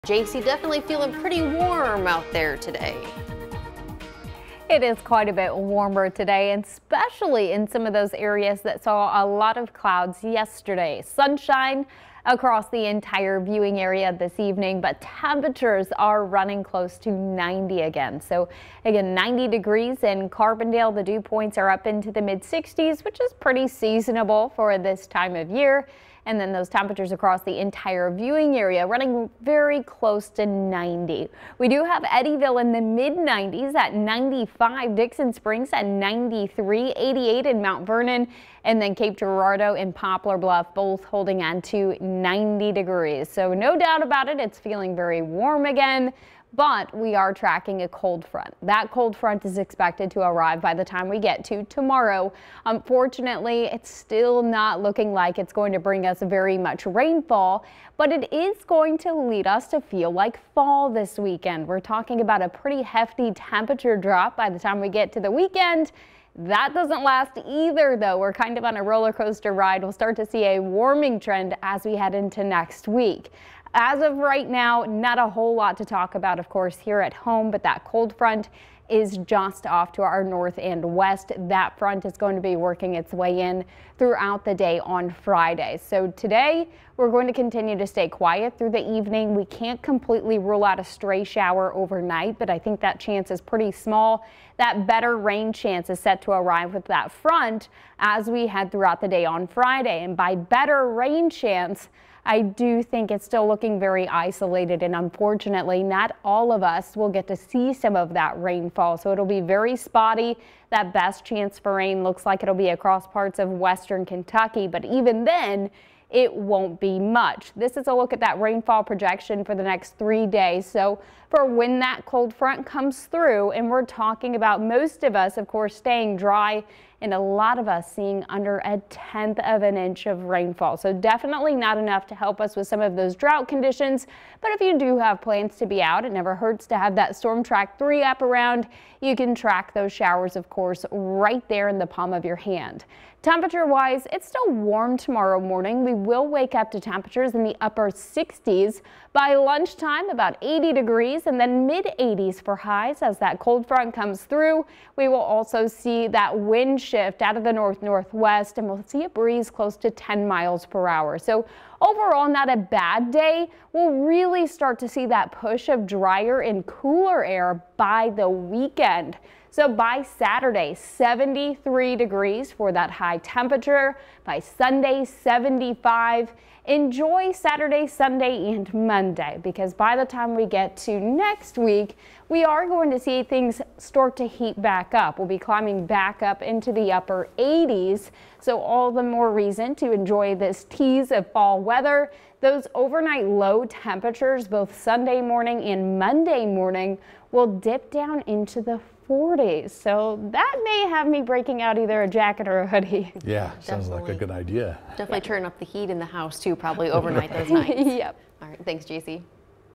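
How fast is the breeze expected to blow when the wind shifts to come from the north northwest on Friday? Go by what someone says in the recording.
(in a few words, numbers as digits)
10 miles per hour.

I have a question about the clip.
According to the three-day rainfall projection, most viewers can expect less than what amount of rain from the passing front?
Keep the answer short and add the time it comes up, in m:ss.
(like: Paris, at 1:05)
a tenth of an inch, at 2:08.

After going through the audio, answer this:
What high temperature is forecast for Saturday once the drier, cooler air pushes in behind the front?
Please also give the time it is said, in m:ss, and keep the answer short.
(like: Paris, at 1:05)
73 degrees, at 2:50.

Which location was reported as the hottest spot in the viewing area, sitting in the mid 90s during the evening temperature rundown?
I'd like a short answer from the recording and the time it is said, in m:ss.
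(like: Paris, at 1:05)
Eddyville, at 0:32.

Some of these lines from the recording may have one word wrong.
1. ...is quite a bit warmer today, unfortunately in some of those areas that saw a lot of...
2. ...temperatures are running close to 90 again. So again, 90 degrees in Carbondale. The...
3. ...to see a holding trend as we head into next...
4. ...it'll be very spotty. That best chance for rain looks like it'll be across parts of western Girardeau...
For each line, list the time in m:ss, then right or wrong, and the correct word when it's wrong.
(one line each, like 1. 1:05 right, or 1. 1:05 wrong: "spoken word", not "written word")
1. 0:04 wrong: "especially", not "unfortunately"
2. 0:15 right
3. 1:10 wrong: "warming", not "holding"
4. 1:49 wrong: "Kentucky", not "Girardeau".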